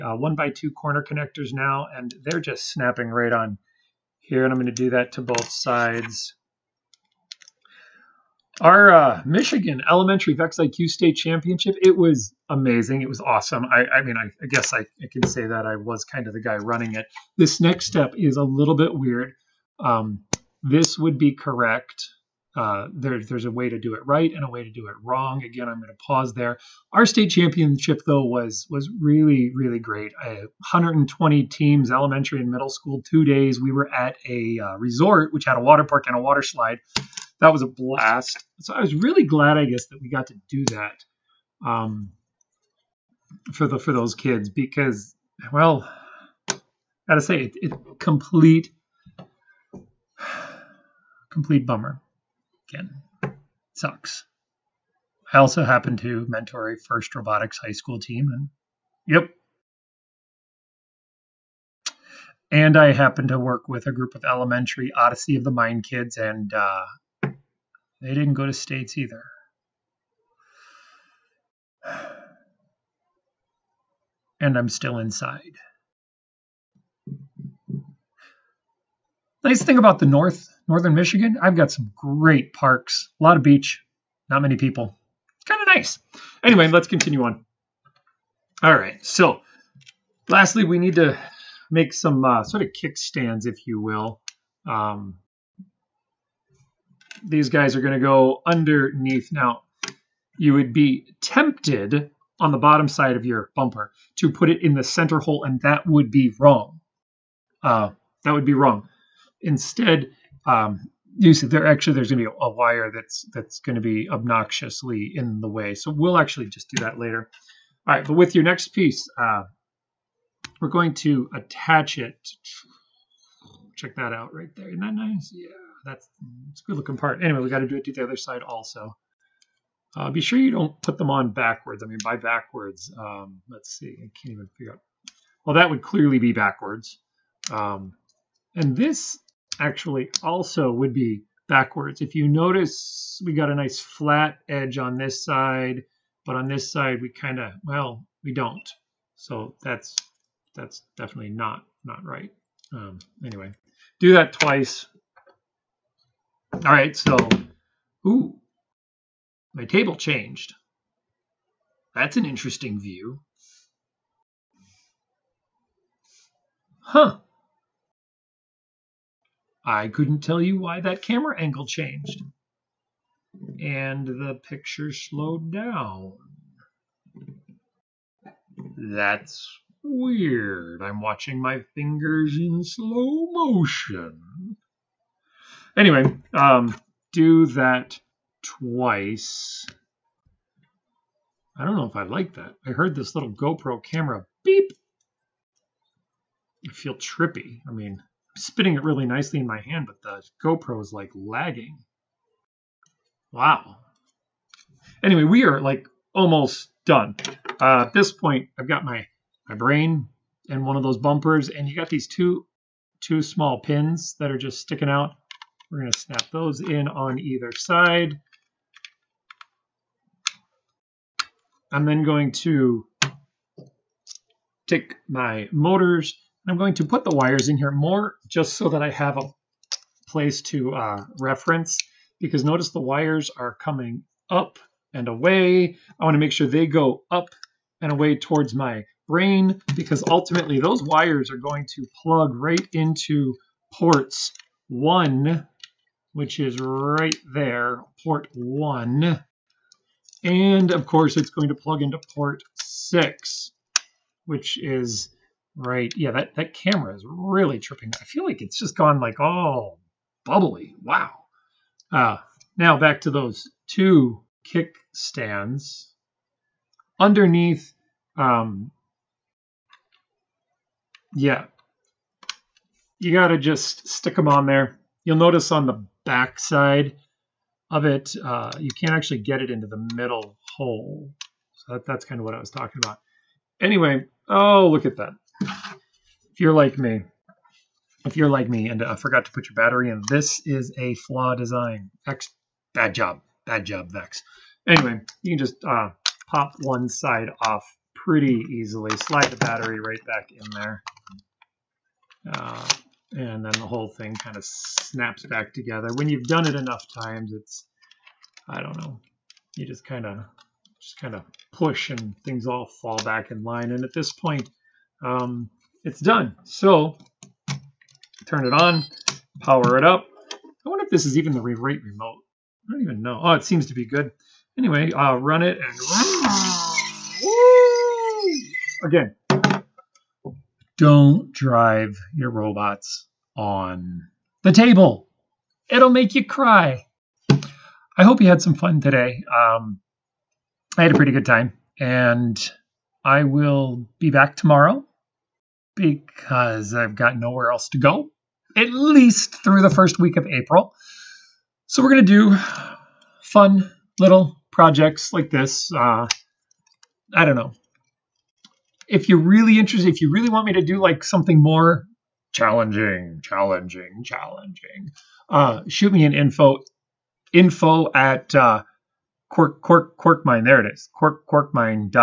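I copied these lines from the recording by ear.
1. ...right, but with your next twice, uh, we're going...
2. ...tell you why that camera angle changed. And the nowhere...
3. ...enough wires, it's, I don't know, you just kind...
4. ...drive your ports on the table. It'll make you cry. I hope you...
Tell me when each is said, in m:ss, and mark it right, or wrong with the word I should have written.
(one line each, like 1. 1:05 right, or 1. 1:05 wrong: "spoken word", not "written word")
1. 1:57 wrong: "piece", not "twice"
2. 2:50 wrong: "picture", not "nowhere"
3. 5:06 wrong: "times", not "wires"
4. 5:31 wrong: "robots", not "ports".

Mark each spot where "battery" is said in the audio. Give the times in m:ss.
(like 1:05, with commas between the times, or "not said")
4:49, 4:59.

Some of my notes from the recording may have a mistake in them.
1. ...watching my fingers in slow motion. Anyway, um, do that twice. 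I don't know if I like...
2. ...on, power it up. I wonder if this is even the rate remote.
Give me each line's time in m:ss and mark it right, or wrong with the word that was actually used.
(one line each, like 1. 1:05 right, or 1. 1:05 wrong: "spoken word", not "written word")
1. 3:01 right
2. 5:18 right.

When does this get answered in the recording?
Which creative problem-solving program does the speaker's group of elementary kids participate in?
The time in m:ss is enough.
1:04.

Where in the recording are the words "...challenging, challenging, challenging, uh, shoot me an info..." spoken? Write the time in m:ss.
6:02.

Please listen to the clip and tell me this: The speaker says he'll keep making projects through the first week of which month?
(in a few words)
April.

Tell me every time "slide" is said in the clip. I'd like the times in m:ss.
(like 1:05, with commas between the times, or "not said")
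0:36, 4:58.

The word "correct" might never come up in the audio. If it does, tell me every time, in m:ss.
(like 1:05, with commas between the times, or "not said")
0:21.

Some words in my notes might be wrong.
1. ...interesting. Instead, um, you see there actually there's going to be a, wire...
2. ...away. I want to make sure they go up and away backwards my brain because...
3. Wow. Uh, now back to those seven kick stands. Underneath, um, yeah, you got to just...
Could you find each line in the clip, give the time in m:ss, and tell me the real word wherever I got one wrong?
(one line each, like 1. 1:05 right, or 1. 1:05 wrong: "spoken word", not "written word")
1. 1:48 wrong: "wrong", not "interesting"
2. 3:55 wrong: "towards", not "backwards"
3. 4:20 wrong: "two", not "seven".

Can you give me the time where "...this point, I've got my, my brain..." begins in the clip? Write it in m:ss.
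3:27.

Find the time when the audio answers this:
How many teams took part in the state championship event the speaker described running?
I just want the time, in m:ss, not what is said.
0:30.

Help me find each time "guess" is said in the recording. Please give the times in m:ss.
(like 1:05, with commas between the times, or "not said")
0:14, 0:39.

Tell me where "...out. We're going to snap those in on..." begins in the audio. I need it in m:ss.
3:34.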